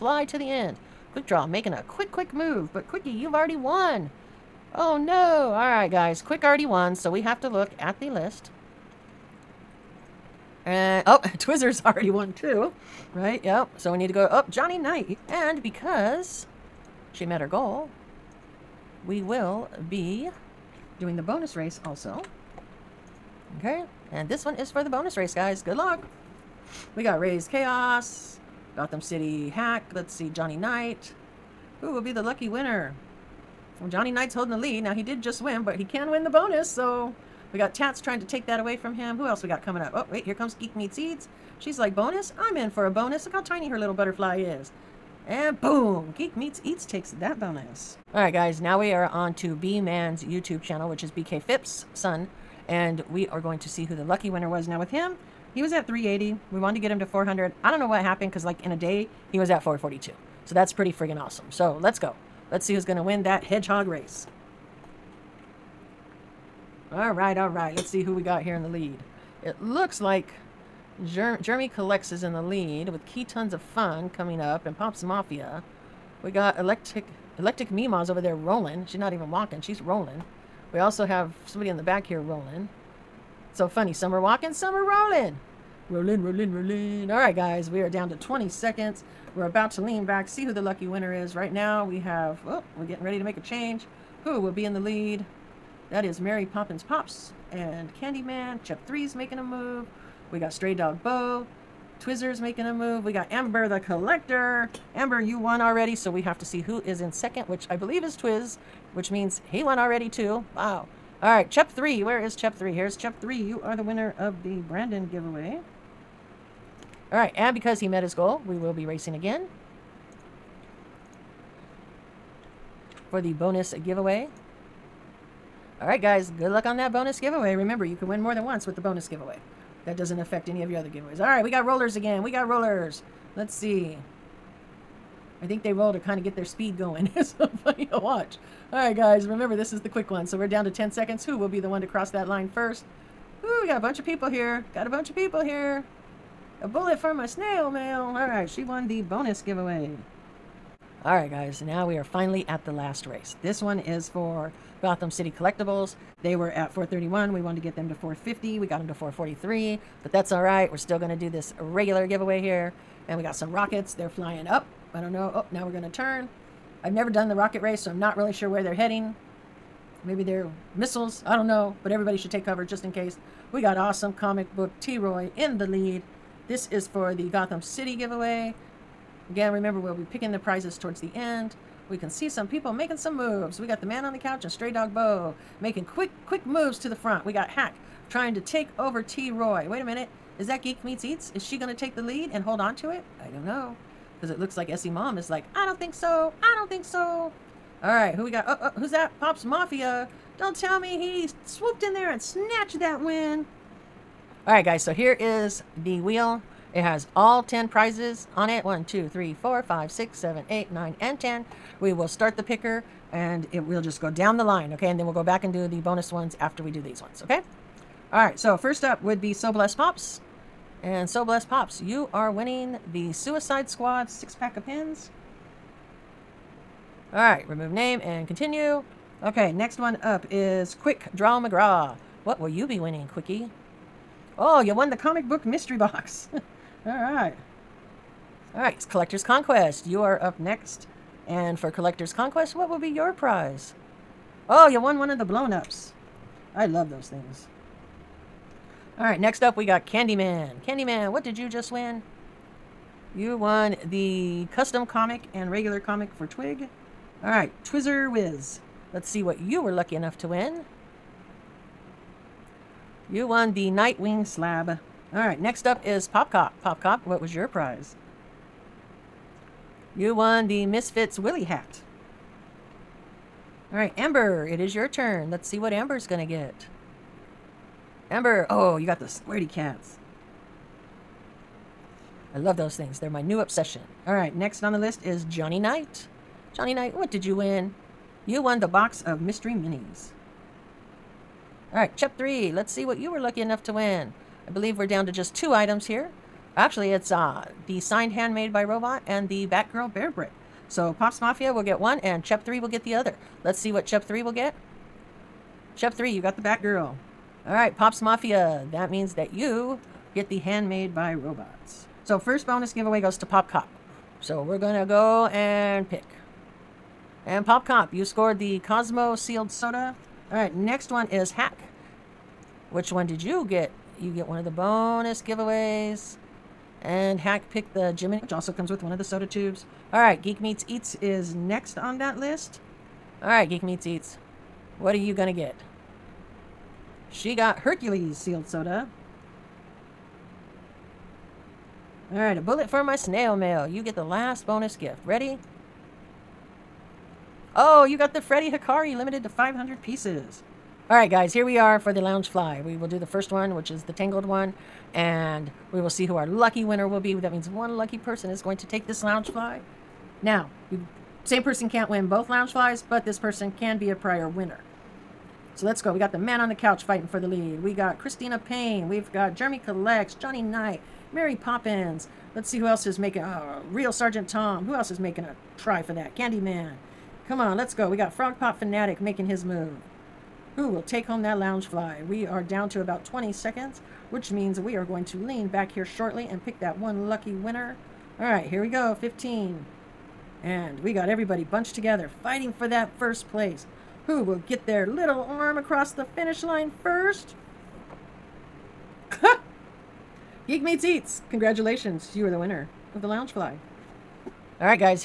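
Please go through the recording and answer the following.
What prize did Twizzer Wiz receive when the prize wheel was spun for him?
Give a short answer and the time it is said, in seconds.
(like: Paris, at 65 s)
Nightwing slab, at 263 s.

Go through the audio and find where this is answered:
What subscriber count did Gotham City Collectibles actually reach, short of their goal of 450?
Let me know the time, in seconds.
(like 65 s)
158 s.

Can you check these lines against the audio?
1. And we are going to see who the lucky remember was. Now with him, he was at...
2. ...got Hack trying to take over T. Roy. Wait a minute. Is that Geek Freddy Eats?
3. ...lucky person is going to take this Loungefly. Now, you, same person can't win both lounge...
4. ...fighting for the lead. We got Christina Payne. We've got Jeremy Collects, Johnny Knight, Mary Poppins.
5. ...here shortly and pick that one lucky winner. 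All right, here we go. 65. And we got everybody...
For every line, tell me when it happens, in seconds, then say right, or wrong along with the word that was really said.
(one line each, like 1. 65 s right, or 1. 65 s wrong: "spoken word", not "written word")
1. 52 s wrong: "winner", not "remember"
2. 187 s wrong: "Meets", not "Freddy"
3. 357 s right
4. 366 s right
5. 385 s wrong: "15", not "65".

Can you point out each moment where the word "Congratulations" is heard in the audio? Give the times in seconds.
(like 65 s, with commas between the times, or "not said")
401 s.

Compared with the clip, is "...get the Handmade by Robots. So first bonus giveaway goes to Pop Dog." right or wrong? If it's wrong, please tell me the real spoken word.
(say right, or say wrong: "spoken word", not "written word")
wrong: "Cop", not "Dog".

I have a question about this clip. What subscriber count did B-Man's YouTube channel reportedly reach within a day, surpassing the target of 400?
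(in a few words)
442.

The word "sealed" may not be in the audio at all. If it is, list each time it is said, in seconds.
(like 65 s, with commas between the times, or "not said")
319 s, 338 s.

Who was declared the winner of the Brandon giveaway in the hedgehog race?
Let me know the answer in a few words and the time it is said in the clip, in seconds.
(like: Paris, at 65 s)
Chep 3, at 113 s.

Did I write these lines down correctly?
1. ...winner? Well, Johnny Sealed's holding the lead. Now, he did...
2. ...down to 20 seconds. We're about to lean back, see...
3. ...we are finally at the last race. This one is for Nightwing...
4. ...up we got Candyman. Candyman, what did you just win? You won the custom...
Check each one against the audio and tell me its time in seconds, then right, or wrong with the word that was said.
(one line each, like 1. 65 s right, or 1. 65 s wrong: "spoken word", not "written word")
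1. 32 s wrong: "Knight", not "Sealed"
2. 87 s right
3. 151 s wrong: "Gotham", not "Nightwing"
4. 249 s right.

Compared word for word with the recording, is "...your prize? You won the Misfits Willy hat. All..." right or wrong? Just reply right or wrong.
right.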